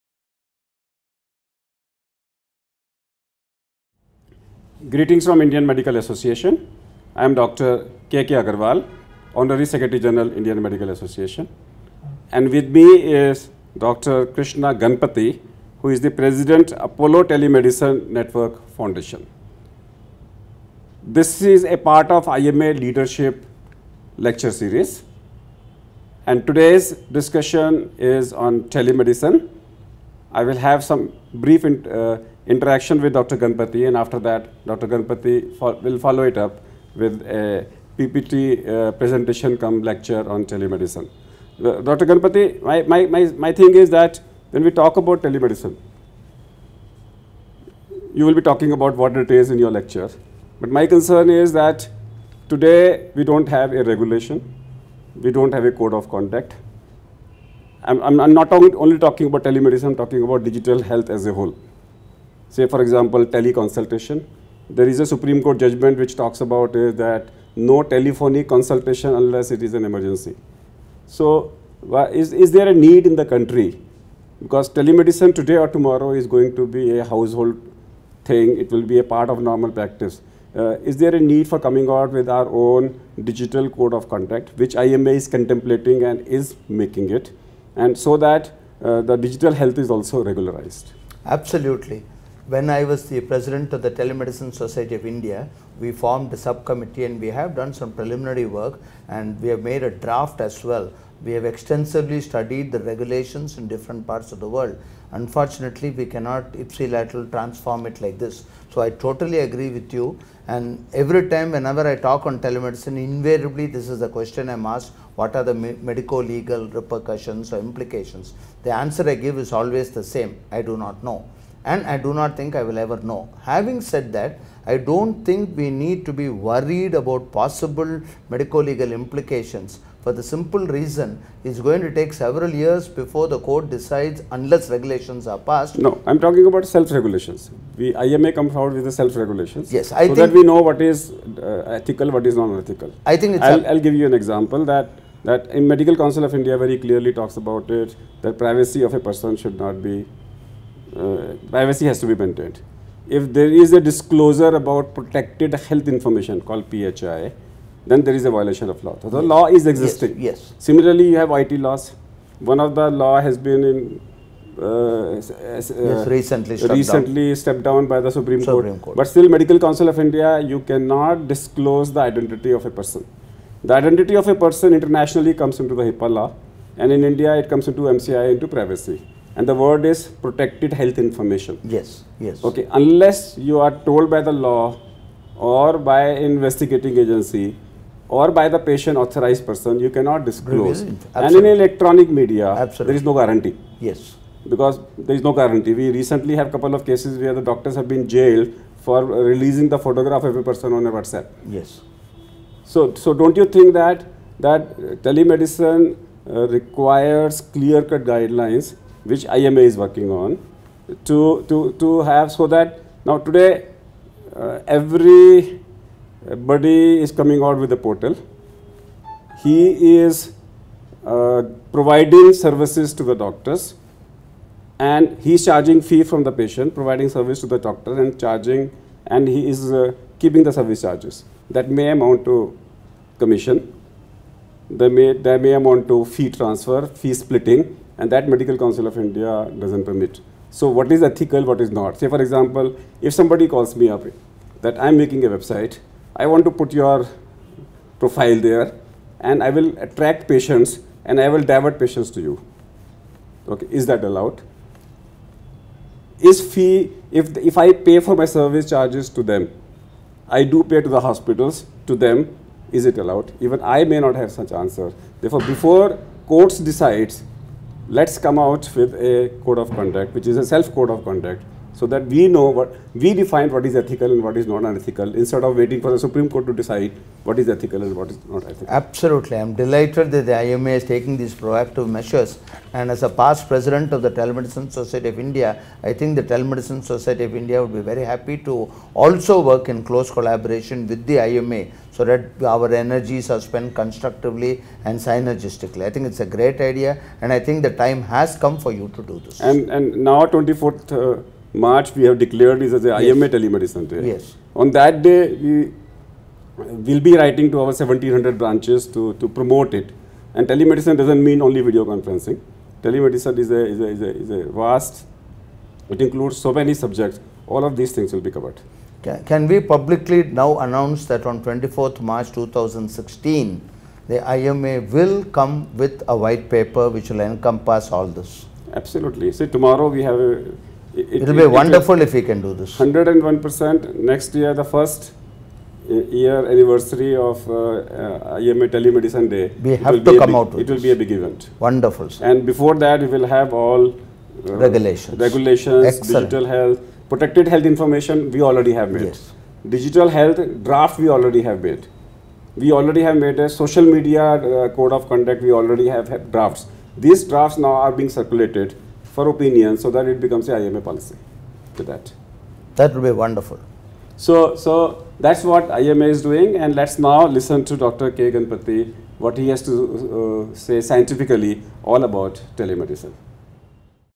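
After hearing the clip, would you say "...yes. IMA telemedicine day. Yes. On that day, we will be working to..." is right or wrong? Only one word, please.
wrong.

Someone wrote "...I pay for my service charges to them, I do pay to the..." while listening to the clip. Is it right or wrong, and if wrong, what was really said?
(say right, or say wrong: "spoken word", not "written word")
right.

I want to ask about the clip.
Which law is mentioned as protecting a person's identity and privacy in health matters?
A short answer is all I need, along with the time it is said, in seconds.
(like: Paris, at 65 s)
HIPAA, at 175 s.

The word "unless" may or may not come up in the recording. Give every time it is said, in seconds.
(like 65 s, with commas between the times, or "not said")
69 s, 134 s, 182 s.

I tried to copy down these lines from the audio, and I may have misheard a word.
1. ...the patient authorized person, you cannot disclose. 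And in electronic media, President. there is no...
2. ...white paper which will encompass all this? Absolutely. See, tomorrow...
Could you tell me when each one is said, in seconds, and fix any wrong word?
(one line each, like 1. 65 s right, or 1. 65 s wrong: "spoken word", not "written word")
1. 188 s wrong: "Absolutely", not "President"
2. 326 s right.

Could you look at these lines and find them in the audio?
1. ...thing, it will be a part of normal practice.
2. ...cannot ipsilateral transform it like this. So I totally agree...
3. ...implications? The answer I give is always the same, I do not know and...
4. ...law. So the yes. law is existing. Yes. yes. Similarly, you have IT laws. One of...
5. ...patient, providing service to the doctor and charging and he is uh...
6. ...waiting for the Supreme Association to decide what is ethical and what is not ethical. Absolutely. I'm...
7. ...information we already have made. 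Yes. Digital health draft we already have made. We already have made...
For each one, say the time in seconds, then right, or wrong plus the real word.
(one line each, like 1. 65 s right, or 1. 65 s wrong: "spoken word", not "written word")
1. 78 s right
2. 106 s right
3. 117 s right
4. 158 s right
5. 226 s right
6. 275 s wrong: "Court", not "Association"
7. 347 s right.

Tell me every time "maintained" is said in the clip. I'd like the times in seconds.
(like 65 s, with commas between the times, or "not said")
152 s.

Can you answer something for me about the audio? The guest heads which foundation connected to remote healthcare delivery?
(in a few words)
Apollo Telemedicine Network Foundation.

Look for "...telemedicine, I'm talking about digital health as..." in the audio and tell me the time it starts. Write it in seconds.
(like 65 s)
59 s.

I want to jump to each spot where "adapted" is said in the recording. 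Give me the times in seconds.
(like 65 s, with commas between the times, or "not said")
not said.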